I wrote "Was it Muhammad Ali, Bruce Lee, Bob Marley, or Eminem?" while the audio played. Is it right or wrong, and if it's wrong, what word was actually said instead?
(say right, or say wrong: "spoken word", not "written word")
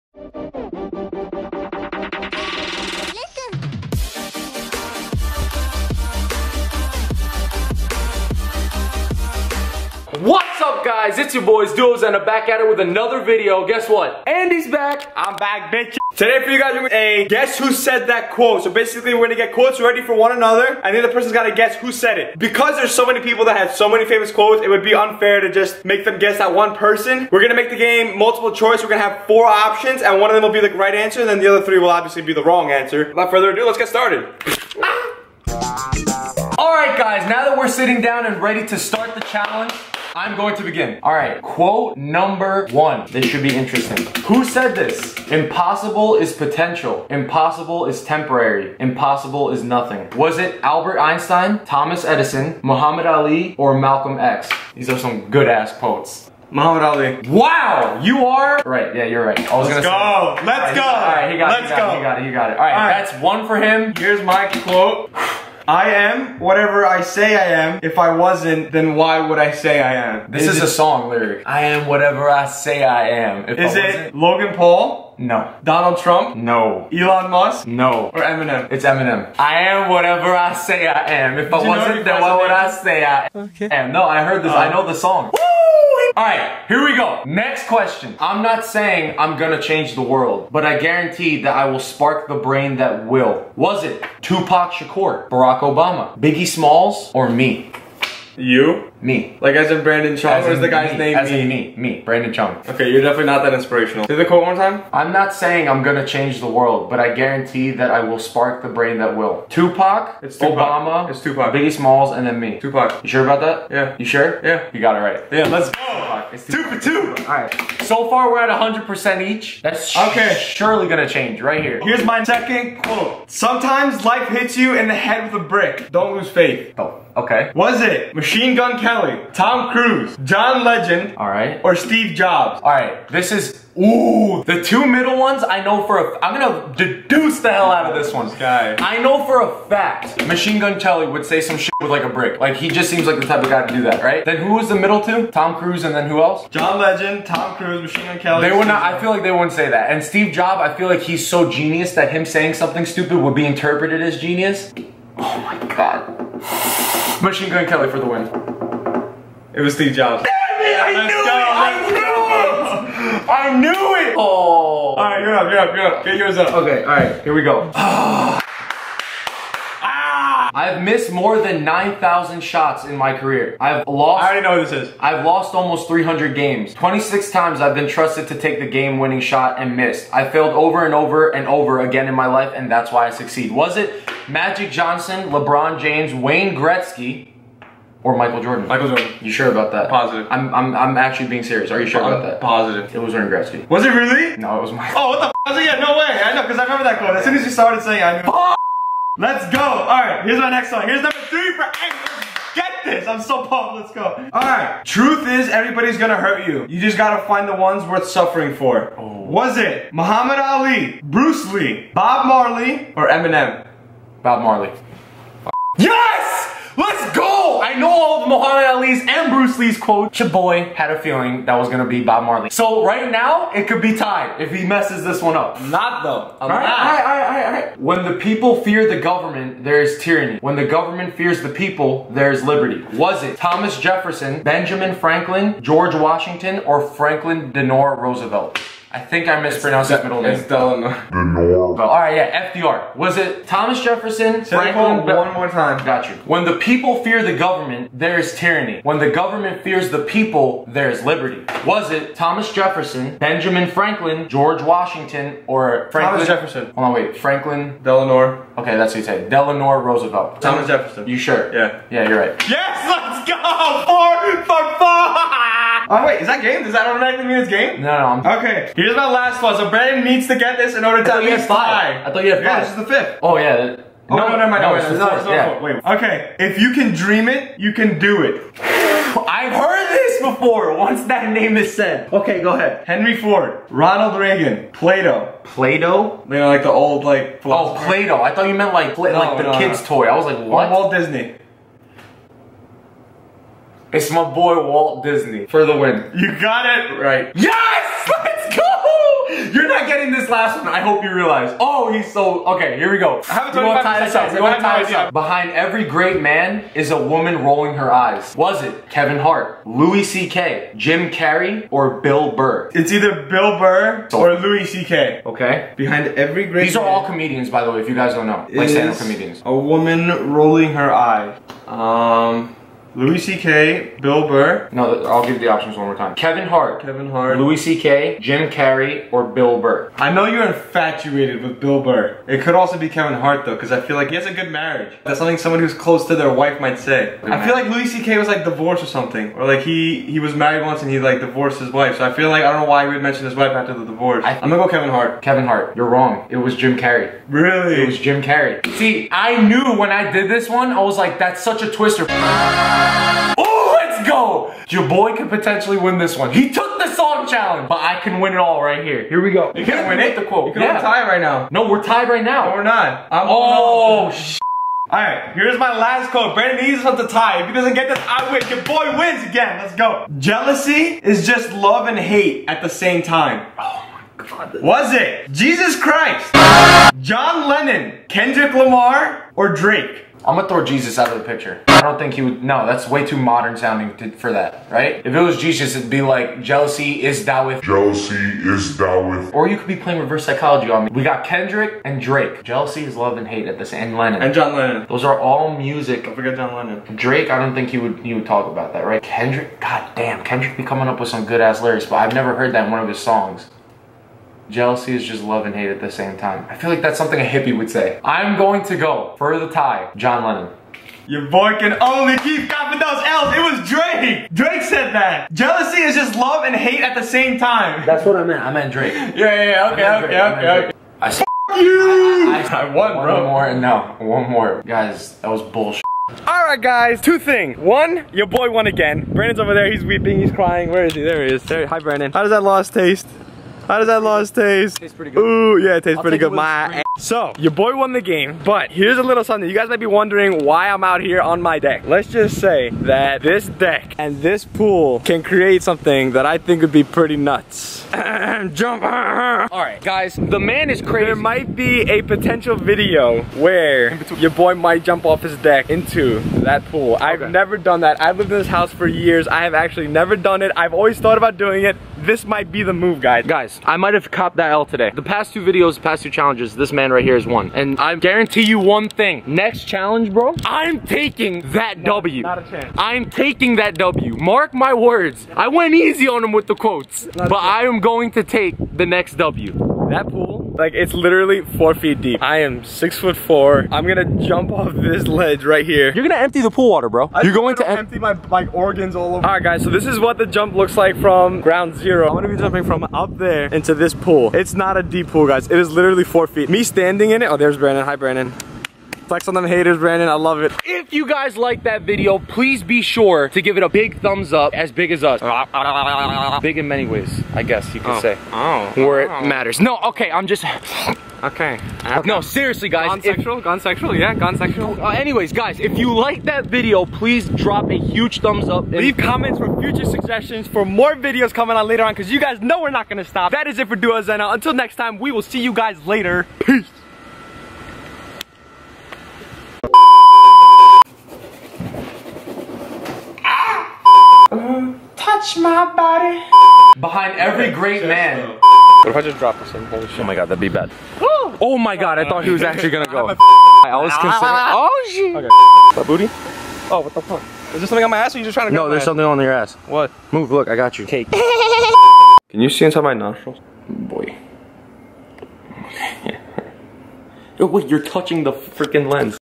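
right.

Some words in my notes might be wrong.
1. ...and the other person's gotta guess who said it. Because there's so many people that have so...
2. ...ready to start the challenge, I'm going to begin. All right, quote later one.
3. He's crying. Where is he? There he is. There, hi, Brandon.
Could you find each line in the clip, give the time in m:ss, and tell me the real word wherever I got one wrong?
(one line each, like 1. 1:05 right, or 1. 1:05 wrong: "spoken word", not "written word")
1. 0:20 right
2. 0:38 wrong: "number", not "later"
3. 7:10 right.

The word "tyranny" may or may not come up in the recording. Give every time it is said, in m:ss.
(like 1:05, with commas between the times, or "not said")
3:50, 4:08.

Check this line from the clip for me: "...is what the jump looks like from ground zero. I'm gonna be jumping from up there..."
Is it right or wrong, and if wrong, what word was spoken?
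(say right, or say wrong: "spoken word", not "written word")
right.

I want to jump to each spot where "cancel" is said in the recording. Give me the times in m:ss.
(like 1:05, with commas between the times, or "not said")
not said.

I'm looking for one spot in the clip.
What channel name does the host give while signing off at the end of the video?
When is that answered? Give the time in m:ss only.
8:43.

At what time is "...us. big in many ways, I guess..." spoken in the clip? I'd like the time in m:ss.
8:25.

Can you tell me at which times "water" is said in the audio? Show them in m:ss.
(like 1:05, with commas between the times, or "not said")
8:06.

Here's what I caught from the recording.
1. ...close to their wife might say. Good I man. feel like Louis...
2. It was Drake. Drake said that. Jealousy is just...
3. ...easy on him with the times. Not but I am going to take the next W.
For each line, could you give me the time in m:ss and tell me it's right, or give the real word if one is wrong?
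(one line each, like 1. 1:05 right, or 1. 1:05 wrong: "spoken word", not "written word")
1. 5:35 right
2. 6:53 right
3. 7:55 wrong: "quotes", not "times".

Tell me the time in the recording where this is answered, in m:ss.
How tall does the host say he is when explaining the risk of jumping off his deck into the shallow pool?
8:02.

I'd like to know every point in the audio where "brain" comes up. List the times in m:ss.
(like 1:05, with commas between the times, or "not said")
1:32, 1:48.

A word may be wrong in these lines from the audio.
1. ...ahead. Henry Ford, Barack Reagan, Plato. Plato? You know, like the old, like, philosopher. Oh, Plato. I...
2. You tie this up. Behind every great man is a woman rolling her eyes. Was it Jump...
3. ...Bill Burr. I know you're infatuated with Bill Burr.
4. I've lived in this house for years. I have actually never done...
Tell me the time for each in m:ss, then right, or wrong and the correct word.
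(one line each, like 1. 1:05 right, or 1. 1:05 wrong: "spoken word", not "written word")
1. 4:42 wrong: "Ronald", not "Barack"
2. 5:04 wrong: "Kevin", not "Jump"
3. 5:29 right
4. 7:38 right.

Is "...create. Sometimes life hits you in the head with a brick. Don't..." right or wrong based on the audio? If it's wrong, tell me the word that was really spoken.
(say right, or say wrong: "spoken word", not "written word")
wrong: "quote", not "create".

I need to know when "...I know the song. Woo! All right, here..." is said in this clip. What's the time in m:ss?
1:24.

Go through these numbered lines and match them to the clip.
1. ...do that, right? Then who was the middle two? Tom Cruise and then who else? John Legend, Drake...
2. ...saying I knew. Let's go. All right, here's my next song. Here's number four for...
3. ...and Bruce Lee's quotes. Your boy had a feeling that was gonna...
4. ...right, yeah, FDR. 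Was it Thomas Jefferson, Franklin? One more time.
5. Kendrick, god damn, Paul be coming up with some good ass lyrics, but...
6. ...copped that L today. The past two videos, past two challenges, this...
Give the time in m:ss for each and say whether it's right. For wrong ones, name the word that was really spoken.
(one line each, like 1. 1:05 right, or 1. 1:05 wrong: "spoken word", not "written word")
1. 2:23 wrong: "Tom", not "Drake"
2. 3:17 wrong: "three", not "four"
3. 3:39 right
4. 4:01 right
5. 6:39 wrong: "Kendrick", not "Paul"
6. 7:44 right.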